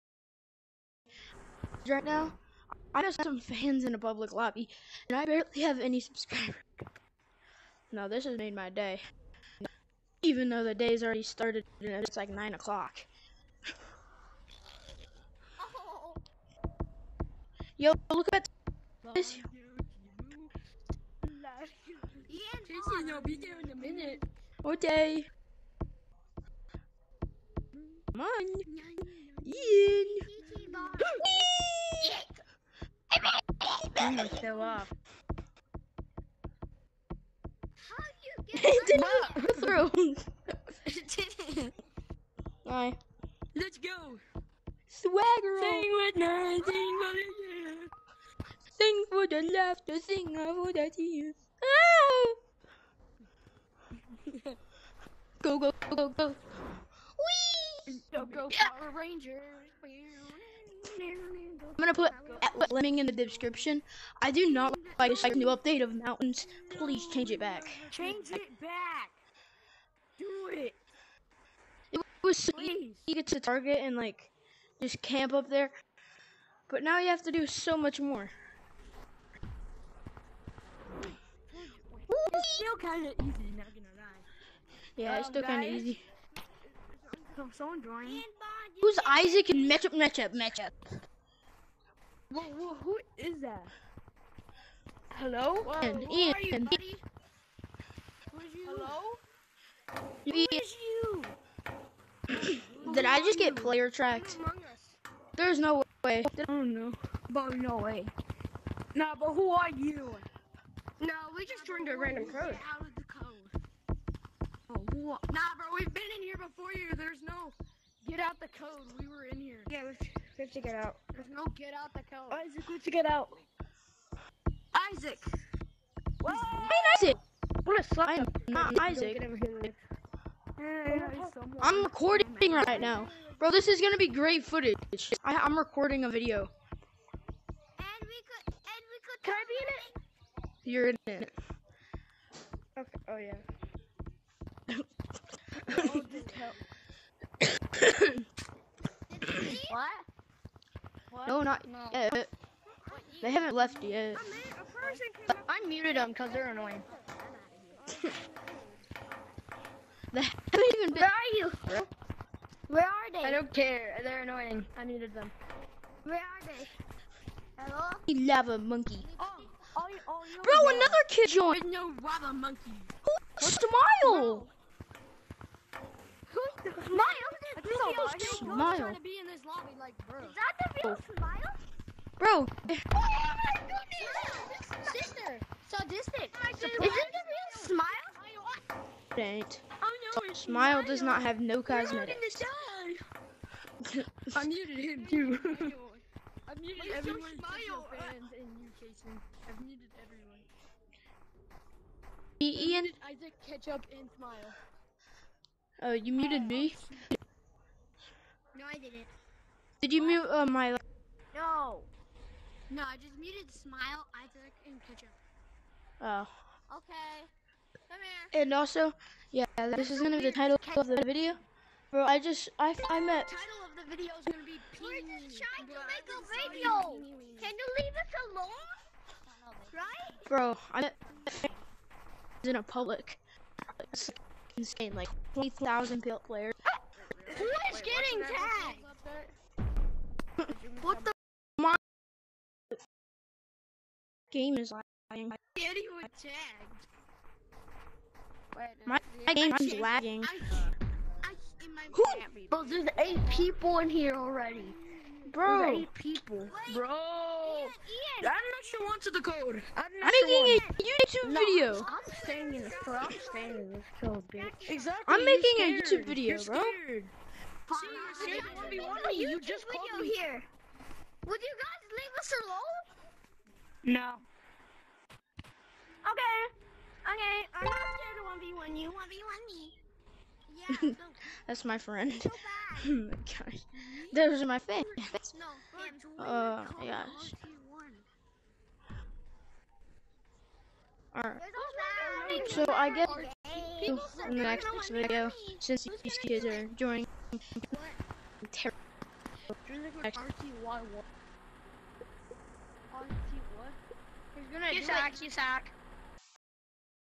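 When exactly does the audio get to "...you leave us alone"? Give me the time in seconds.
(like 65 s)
227 s.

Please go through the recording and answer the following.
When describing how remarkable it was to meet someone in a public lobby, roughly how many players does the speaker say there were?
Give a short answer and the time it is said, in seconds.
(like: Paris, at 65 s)
20,000, at 235 s.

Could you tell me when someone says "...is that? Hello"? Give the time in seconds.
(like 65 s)
93 s.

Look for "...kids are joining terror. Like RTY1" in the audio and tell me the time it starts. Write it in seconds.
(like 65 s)
296 s.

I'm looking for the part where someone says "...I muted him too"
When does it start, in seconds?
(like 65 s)
194 s.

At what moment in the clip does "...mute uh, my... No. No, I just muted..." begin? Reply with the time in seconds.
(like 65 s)
210 s.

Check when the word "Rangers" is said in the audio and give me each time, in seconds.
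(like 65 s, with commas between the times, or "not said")
58 s.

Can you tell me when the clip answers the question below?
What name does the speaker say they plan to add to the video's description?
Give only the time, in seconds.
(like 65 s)
62 s.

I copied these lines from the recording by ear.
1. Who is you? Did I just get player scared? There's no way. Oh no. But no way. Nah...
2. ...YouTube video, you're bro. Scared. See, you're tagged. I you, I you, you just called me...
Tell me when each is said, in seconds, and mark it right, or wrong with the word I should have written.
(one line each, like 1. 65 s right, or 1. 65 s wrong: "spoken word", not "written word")
1. 100 s wrong: "tracked", not "scared"
2. 265 s wrong: "scared", not "tagged".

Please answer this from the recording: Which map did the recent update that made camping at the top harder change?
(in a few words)
Mountains.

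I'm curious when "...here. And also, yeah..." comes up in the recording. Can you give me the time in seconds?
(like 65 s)
218 s.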